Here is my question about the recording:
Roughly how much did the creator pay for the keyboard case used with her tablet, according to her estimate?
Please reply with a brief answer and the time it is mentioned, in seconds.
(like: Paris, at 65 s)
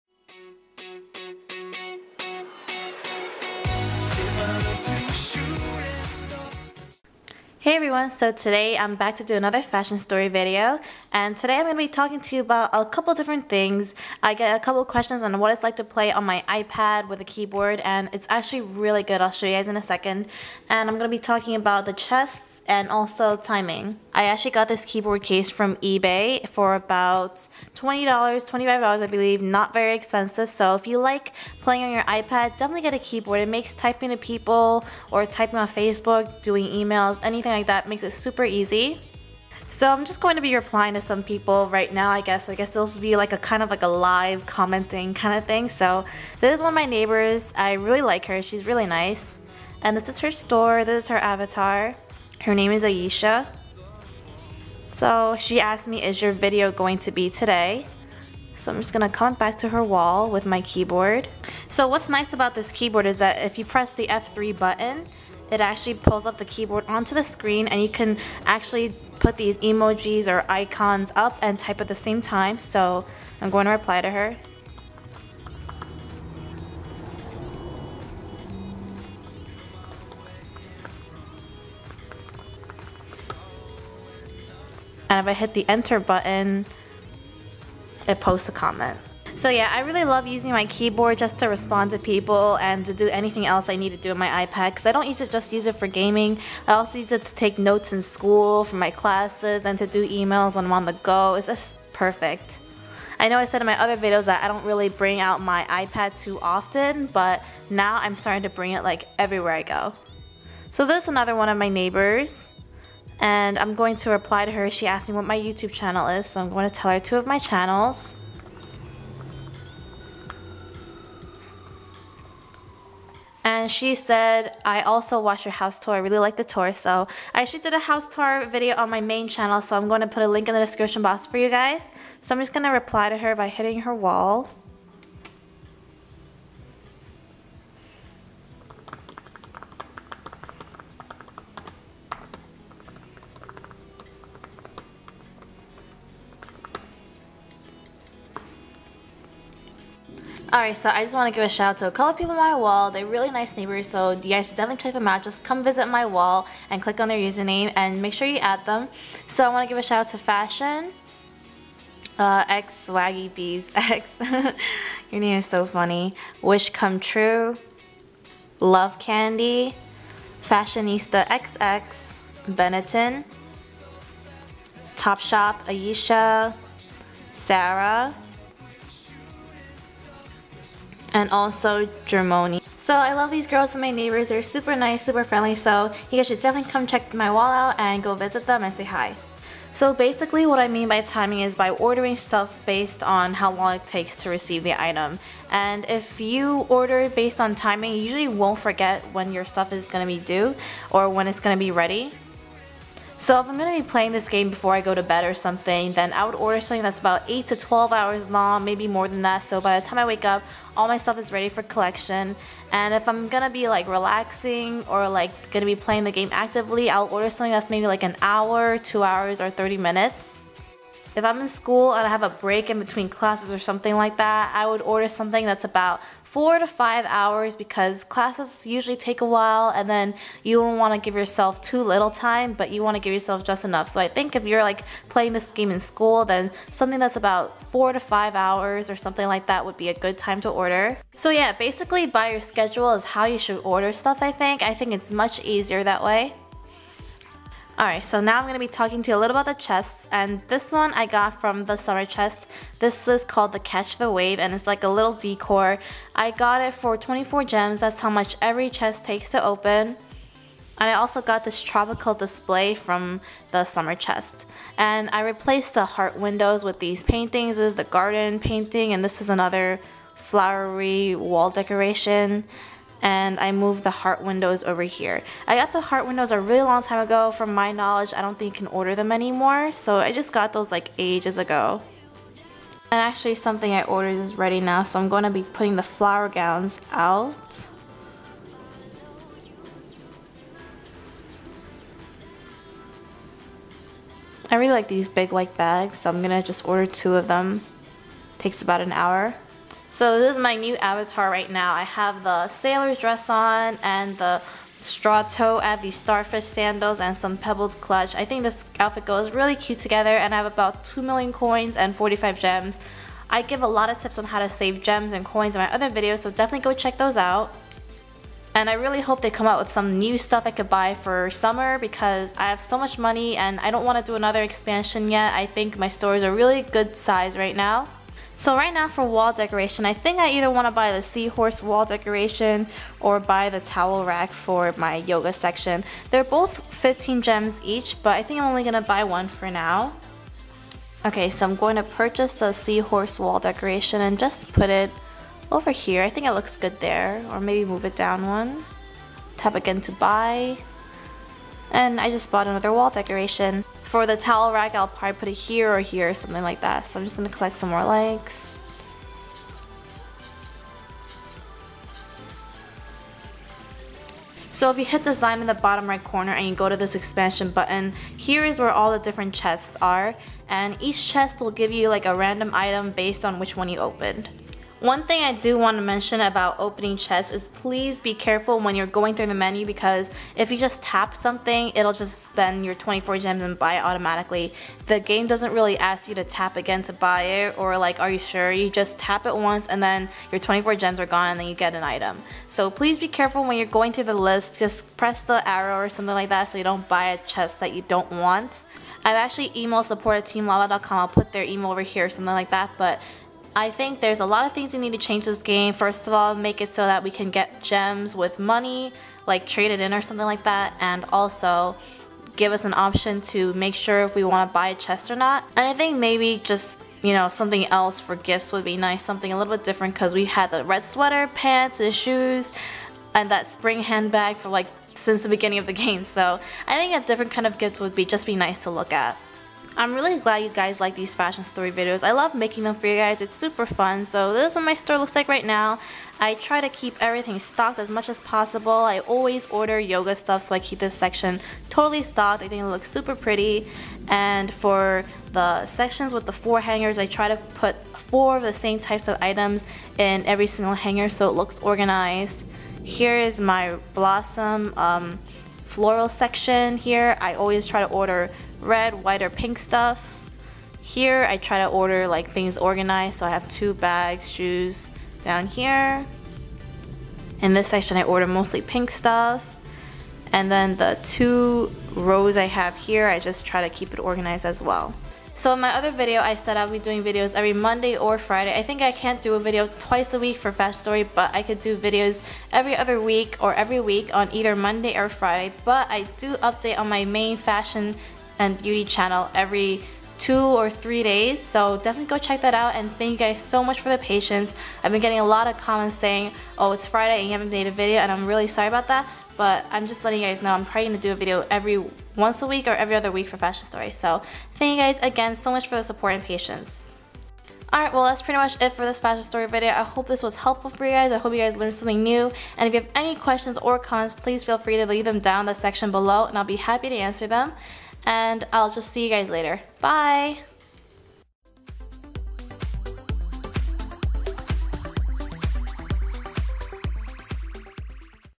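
$20-$25, at 27 s.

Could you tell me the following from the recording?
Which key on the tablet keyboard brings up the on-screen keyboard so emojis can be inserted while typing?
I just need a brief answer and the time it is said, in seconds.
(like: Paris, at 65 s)
F3, at 64 s.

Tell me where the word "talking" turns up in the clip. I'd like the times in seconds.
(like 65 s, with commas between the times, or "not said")
11 s, 21 s, 248 s.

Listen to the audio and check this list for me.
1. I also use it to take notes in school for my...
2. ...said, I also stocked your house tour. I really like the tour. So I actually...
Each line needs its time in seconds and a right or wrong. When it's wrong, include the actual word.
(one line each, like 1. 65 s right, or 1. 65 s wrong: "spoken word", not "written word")
1. 96 s right
2. 123 s wrong: "watched", not "stocked".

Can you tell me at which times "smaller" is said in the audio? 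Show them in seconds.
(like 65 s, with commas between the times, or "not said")
not said.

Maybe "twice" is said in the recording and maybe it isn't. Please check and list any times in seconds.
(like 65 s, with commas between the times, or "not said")
479 s.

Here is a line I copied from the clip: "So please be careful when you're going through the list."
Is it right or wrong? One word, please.
right.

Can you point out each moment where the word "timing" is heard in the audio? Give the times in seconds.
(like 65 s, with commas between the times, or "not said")
23 s, 191 s, 197 s.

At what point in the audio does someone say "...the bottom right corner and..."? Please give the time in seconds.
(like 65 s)
365 s.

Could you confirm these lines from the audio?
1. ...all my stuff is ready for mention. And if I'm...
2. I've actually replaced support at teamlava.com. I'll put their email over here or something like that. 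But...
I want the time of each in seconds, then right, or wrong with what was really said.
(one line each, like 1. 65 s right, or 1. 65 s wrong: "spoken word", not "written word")
1. 210 s wrong: "collection", not "mention"
2. 399 s wrong: "emailed", not "replaced".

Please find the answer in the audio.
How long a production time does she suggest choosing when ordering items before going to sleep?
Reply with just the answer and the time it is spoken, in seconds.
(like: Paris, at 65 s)
8 to 12 hours, at 207 s.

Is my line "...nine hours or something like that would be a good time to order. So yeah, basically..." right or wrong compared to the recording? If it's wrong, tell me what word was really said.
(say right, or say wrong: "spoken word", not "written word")
wrong: "five", not "nine".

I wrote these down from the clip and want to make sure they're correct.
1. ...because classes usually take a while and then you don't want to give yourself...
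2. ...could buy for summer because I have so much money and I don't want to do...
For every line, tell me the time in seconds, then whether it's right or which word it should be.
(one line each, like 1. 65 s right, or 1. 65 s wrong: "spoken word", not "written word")
1. 227 s right
2. 320 s right.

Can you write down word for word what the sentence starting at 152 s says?
They're really nice neighbors, so you guys should definitely check them out.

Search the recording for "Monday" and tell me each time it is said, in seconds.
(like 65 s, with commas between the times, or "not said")
477 s, 484 s.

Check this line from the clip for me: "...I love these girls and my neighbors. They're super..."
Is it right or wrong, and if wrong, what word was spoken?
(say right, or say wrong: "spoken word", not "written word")
right.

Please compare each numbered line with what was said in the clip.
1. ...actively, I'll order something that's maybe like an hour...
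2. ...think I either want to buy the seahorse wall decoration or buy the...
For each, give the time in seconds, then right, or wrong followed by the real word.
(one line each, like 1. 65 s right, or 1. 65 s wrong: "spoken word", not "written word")
1. 216 s right
2. 329 s right.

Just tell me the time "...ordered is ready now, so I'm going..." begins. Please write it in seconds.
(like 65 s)
283 s.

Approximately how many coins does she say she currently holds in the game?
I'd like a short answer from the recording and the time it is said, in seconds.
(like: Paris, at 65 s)
2 million, at 310 s.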